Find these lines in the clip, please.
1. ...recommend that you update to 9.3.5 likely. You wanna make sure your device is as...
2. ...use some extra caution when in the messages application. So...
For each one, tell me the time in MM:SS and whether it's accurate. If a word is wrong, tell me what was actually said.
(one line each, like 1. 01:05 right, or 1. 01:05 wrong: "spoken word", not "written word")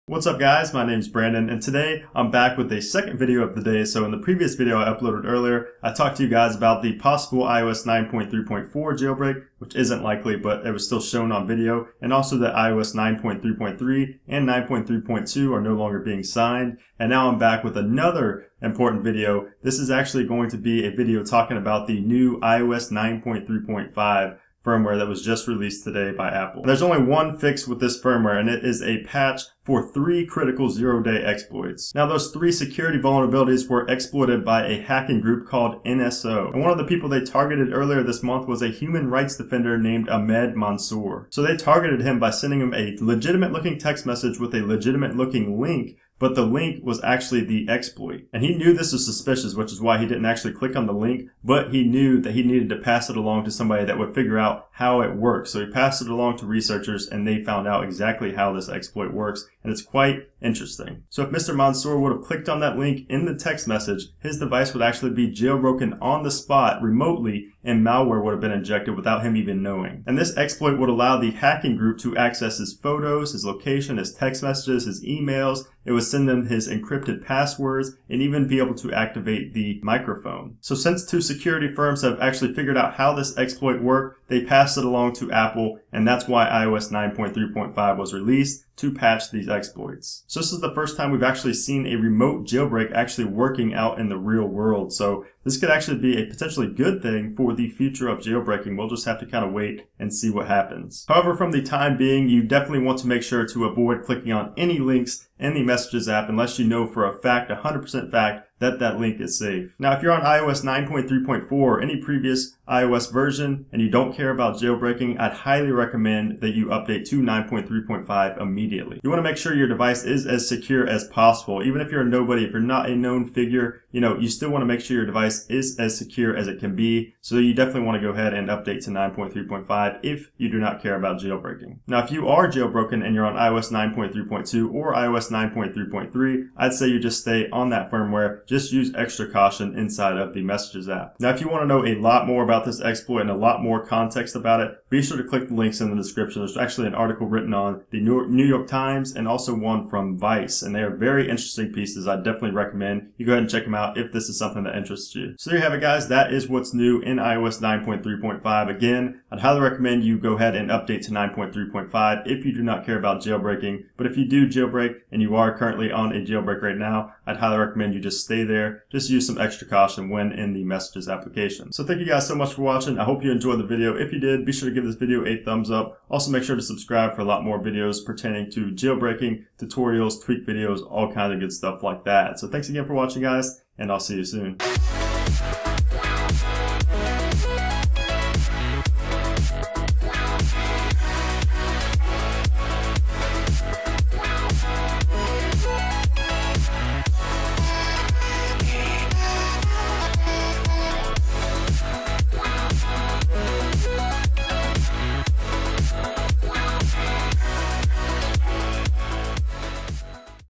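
1. 01:55 wrong: "immediately", not "likely"
2. 02:49 right.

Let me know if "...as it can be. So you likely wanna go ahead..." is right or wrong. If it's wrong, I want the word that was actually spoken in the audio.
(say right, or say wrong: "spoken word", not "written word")
wrong: "definitely", not "likely".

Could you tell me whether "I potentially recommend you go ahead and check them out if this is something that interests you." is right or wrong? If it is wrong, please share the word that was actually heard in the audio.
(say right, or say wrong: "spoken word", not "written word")
wrong: "definitely", not "potentially".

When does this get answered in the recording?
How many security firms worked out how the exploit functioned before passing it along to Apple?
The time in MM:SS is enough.
01:21.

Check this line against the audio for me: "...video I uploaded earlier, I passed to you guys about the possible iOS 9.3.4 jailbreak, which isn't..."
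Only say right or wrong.
wrong.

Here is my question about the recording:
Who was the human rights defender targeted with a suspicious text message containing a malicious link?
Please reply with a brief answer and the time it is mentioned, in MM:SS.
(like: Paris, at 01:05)
Ahmed Mansour, at 00:40.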